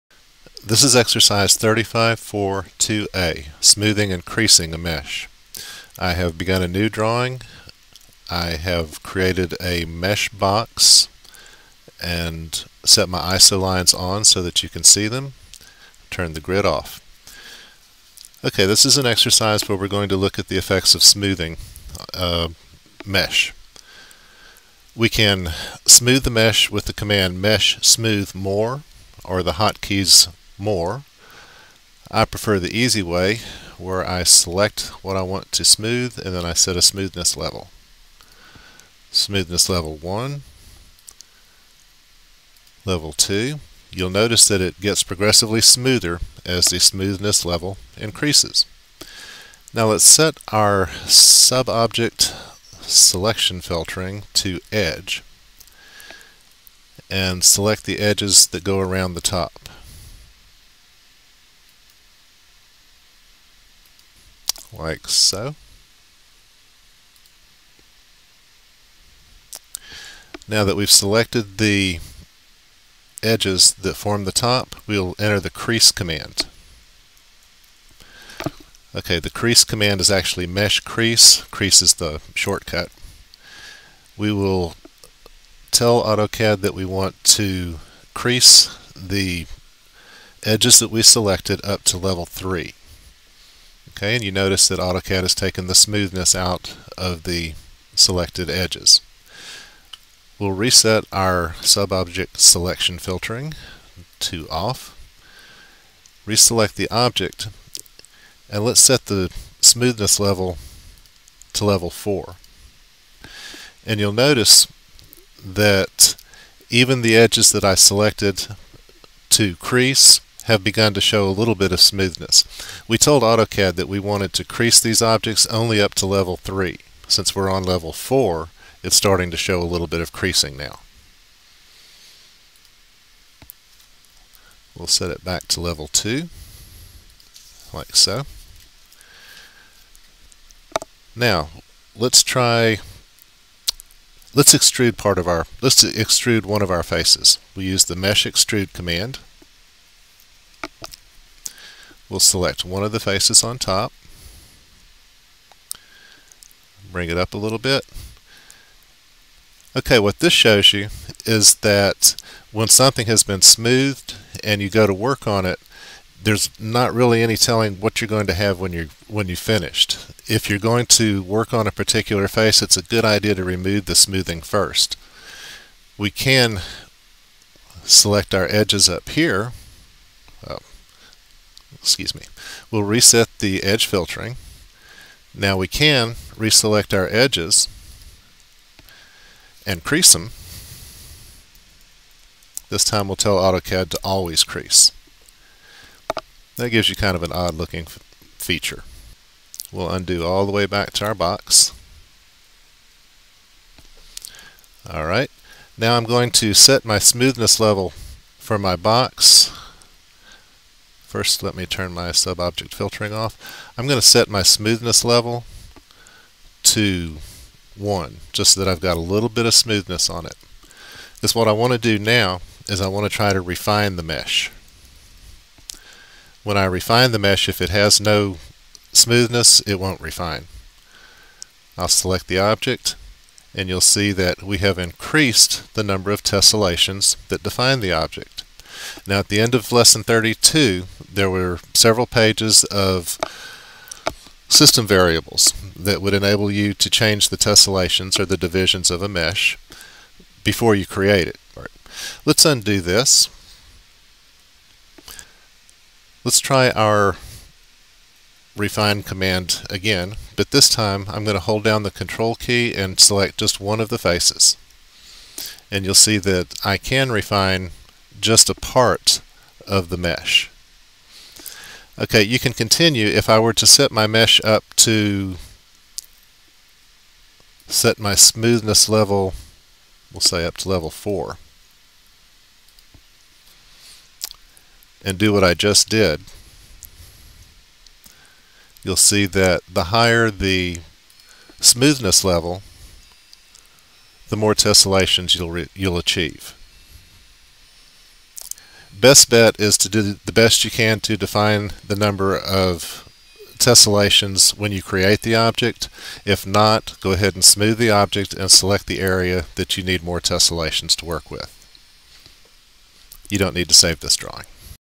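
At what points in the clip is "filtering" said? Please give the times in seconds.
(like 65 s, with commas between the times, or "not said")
53 s, 102 s, 183 s, 212 s.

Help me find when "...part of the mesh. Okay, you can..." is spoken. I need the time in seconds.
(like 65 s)
268 s.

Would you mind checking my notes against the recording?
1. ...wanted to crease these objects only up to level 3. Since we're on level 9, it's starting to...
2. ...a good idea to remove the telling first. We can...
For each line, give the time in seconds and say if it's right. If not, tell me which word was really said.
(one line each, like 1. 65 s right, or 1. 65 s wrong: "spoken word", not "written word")
1. 123 s wrong: "4", not "9"
2. 172 s wrong: "smoothing", not "telling".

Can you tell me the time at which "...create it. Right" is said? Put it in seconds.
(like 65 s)
250 s.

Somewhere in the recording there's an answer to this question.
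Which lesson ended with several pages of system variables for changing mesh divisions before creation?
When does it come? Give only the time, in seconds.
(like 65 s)
239 s.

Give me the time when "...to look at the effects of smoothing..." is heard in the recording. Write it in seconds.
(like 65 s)
20 s.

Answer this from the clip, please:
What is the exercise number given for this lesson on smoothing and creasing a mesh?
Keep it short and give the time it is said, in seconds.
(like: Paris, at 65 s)
35.4.2a, at 1 s.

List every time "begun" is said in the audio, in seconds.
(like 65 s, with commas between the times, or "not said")
6 s, 120 s.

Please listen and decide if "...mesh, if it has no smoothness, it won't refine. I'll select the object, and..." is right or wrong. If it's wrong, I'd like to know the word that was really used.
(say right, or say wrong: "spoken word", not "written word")
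right.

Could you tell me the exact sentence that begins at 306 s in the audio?
If not, go ahead and smooth the object and select the area that you need more tessellations to work with.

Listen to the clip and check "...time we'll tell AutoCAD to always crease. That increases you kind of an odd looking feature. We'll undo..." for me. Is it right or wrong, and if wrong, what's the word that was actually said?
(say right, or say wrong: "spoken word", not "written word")
wrong: "gives", not "increases".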